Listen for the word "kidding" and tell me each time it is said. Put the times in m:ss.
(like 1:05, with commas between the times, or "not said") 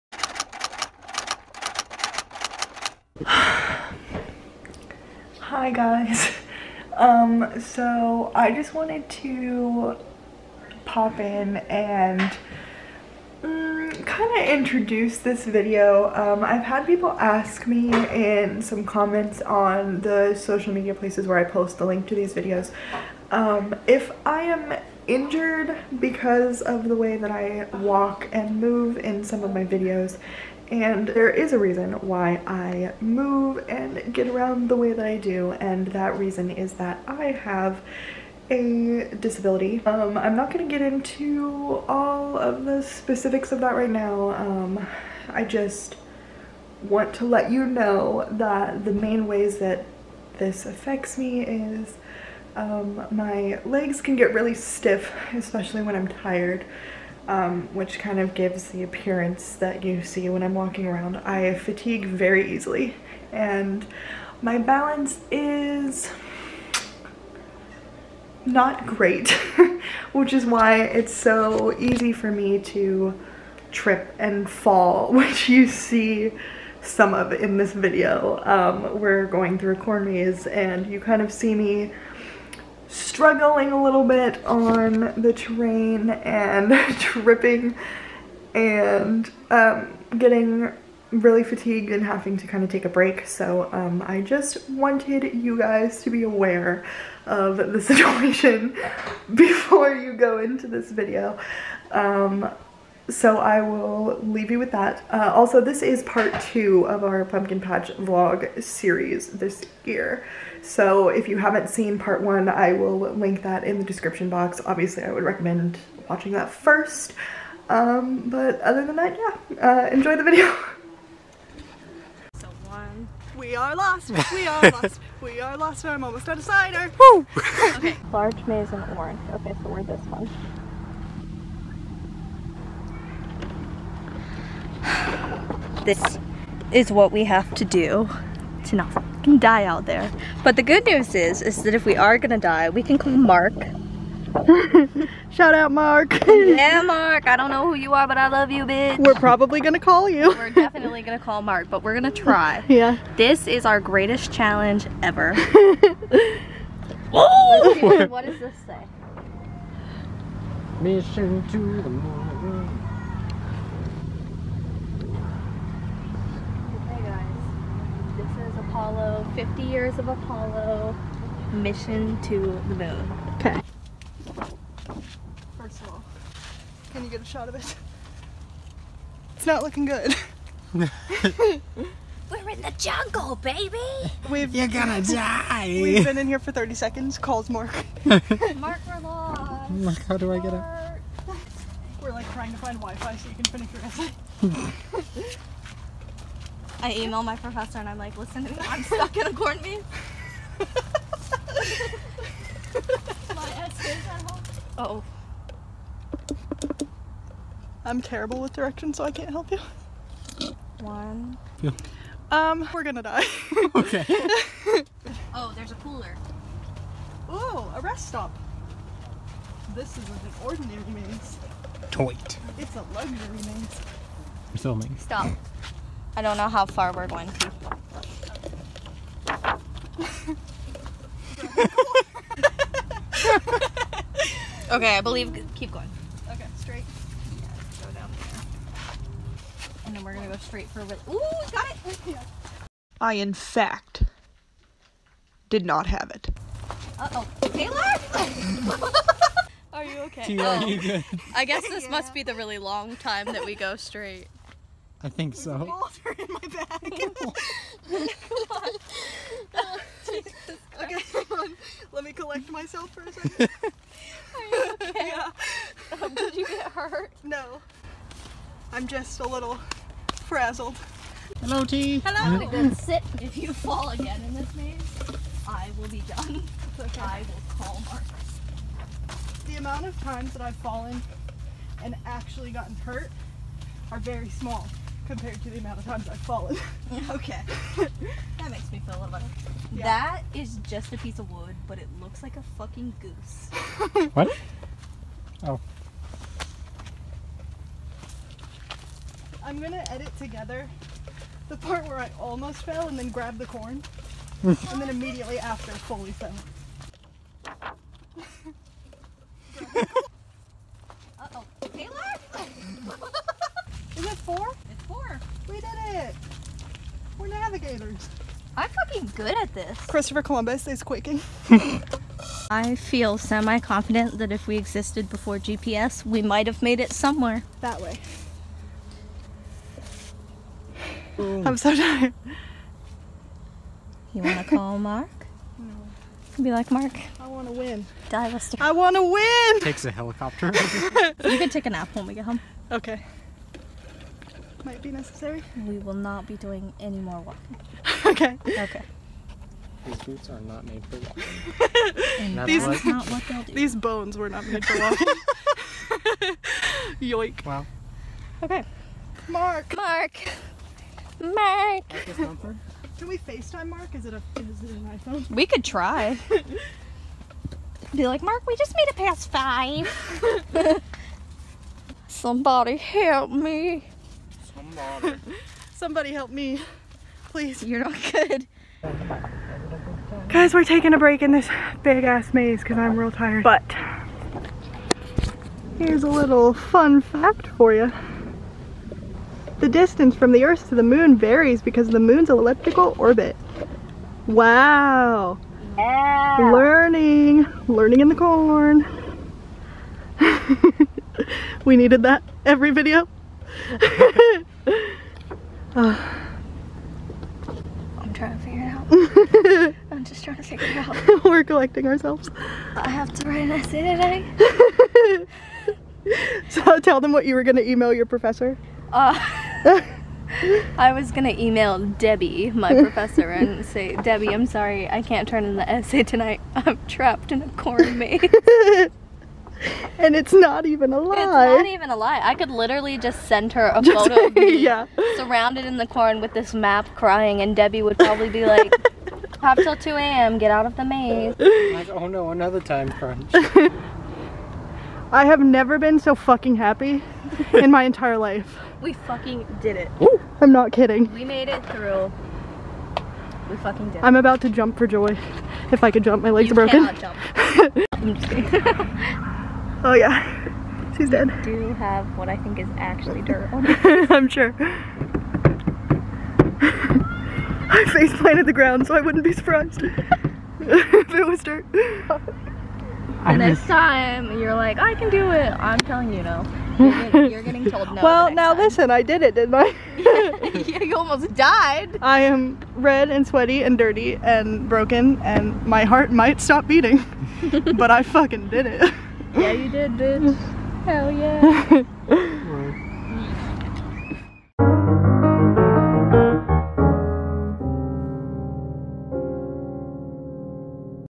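7:30, 7:38.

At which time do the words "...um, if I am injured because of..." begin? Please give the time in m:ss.
0:23.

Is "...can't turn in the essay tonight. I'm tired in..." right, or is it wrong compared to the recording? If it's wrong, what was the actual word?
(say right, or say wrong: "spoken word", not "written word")
wrong: "trapped", not "tired".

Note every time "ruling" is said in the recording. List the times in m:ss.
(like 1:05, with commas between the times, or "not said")
not said.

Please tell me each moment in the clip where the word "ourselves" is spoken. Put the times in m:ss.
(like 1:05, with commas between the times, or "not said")
6:51.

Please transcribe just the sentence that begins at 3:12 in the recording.
We're like trying to find Wi-Fi so you can finish your essay.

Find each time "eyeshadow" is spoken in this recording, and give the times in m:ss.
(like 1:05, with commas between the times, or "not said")
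not said.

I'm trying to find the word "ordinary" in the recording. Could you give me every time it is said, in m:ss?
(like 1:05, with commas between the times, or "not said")
3:40.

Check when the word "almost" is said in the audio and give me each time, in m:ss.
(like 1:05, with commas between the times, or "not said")
2:06, 5:02, 8:00.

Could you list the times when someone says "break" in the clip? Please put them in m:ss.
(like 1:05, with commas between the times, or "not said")
1:32, 6:20.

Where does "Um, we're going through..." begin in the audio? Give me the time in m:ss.
1:18.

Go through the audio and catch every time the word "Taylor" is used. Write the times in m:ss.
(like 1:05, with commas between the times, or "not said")
4:07, 5:11.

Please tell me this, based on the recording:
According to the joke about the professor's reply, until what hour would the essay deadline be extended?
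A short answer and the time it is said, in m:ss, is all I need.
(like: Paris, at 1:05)
2 a.m., at 7:19.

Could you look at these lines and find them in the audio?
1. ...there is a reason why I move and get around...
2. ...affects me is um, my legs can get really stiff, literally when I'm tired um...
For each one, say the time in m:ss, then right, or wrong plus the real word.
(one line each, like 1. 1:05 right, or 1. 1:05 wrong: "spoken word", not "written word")
1. 0:31 right
2. 0:50 wrong: "especially", not "literally".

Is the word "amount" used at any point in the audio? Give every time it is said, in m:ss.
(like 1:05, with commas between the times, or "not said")
4:39, 4:45.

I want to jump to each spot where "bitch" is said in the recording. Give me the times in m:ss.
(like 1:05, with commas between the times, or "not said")
2:28, 8:09.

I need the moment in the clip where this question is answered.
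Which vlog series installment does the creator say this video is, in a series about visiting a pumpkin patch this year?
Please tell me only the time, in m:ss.
1:46.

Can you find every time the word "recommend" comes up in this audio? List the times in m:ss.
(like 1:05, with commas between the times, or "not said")
1:55.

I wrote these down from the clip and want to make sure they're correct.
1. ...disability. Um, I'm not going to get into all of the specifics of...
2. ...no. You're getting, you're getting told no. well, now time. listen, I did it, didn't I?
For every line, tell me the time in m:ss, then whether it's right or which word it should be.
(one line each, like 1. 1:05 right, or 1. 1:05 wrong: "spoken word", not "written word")
1. 0:39 right
2. 7:56 right.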